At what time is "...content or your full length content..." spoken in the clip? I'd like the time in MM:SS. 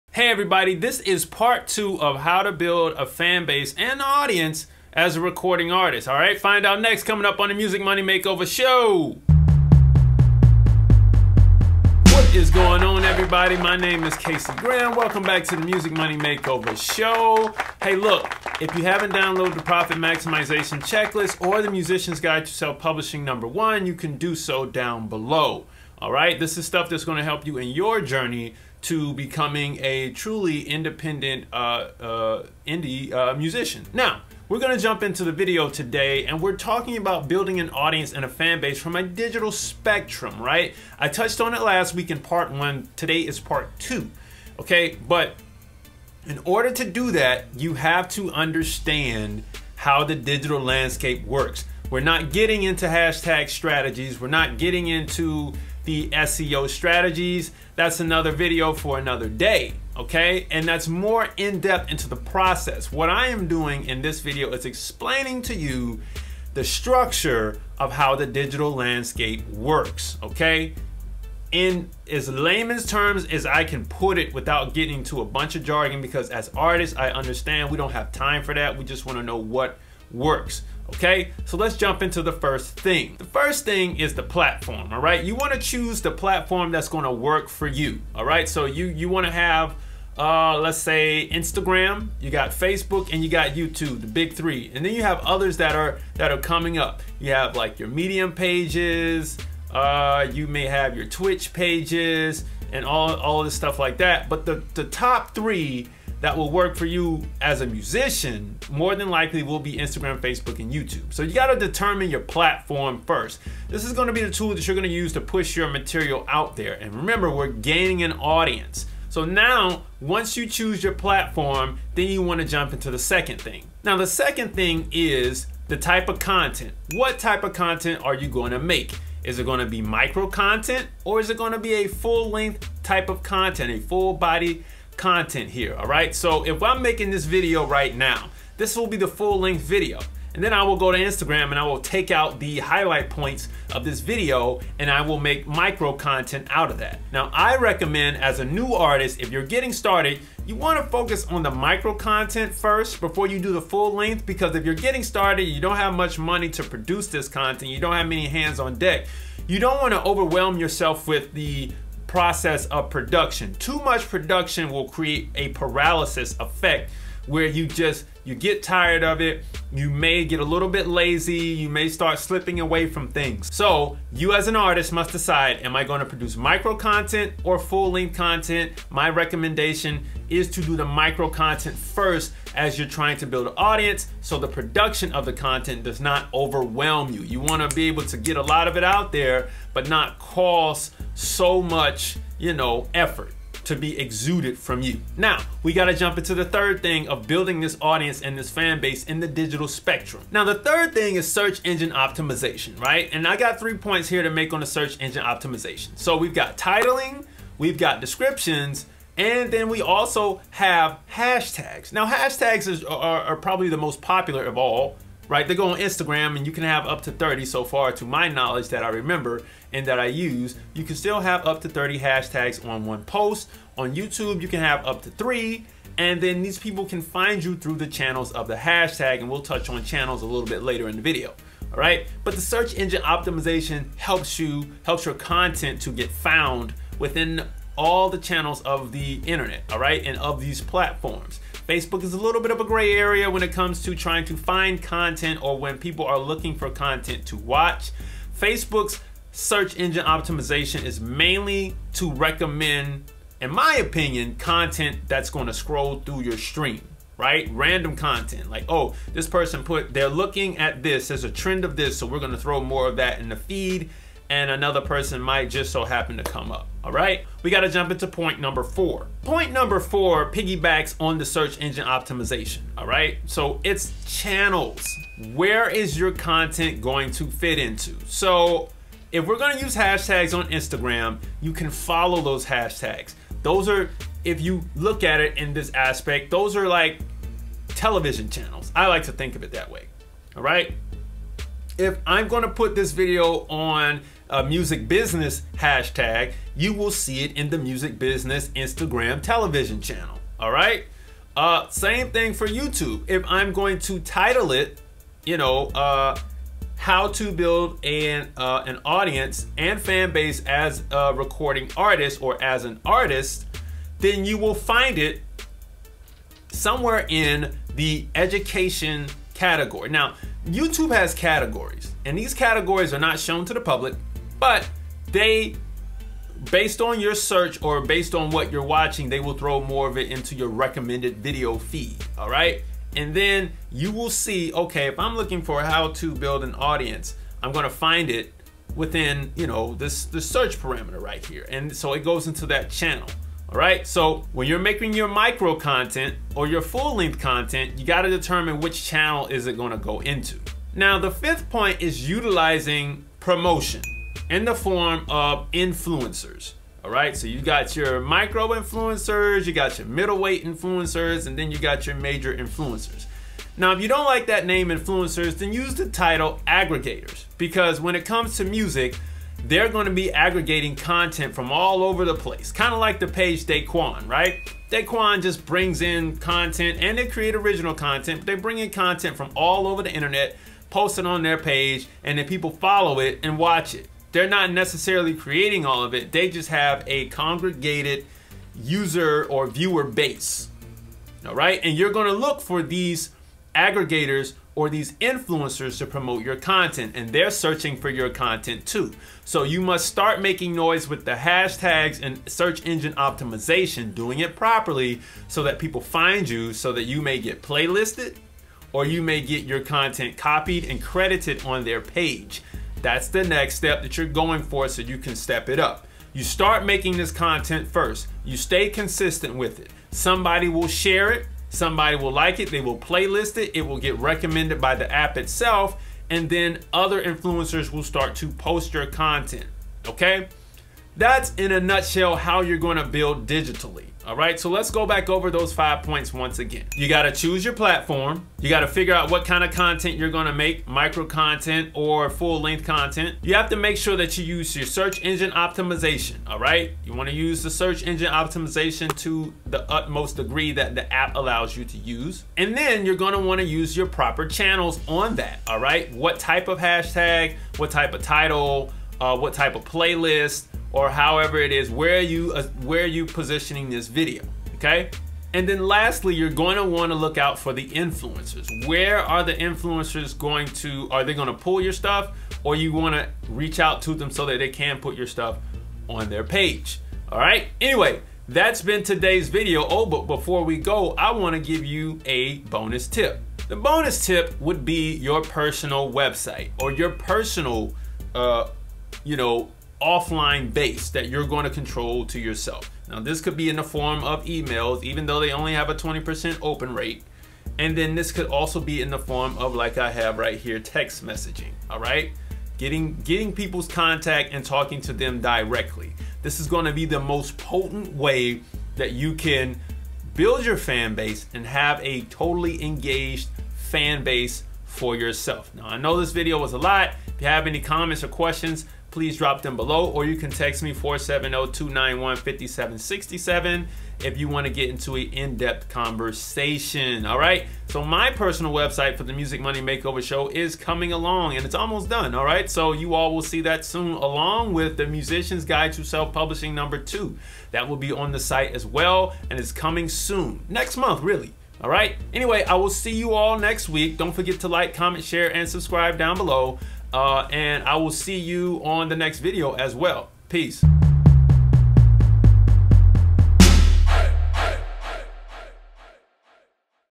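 05:45.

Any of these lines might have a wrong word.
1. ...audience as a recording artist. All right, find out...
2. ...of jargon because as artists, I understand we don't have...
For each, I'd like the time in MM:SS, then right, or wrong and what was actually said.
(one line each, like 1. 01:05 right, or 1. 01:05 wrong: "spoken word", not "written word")
1. 00:04 right
2. 01:15 right.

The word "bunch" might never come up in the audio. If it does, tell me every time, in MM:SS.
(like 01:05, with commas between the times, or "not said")
01:15.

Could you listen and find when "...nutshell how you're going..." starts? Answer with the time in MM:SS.
07:11.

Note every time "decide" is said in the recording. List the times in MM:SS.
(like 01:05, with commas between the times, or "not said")
02:55.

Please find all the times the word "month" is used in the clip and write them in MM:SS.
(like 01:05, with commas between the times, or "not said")
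09:00.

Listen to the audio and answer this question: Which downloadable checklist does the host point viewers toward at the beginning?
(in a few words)
Profit Maximization Checklist.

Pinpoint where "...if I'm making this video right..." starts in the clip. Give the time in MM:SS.
02:16.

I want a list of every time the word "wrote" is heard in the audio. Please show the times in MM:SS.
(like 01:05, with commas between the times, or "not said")
not said.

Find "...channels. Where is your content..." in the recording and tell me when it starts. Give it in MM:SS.
04:34.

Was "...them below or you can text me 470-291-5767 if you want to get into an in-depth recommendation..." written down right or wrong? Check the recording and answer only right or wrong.
wrong.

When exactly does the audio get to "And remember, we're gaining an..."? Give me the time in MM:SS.
01:56.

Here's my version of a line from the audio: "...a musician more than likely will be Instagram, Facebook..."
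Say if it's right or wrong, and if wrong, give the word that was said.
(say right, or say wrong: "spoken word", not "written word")
right.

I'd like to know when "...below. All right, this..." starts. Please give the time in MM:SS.
00:25.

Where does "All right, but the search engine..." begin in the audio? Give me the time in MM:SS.
03:51.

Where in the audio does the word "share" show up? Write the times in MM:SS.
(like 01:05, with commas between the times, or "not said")
07:00, 09:05.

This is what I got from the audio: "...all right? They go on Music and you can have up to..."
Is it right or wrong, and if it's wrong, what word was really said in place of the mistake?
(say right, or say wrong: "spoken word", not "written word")
wrong: "Instagram", not "Music".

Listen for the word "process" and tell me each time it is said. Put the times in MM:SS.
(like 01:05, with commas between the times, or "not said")
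01:02, 02:42.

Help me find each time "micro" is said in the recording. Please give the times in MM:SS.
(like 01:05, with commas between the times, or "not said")
02:09, 02:25, 02:31, 02:56, 03:00, 05:45, 05:57, 07:20.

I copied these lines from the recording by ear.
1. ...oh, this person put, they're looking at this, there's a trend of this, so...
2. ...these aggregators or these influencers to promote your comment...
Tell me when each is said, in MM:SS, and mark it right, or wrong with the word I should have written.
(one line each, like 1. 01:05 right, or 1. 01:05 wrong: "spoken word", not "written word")
1. 04:18 right
2. 06:32 wrong: "content", not "comment".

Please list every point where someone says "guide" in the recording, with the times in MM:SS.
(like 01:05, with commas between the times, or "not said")
00:22, 08:55.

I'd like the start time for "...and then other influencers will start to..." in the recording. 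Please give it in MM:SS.
07:06.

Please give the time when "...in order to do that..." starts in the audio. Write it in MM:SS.
00:46.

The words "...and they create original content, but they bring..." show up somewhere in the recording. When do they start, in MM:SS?
06:16.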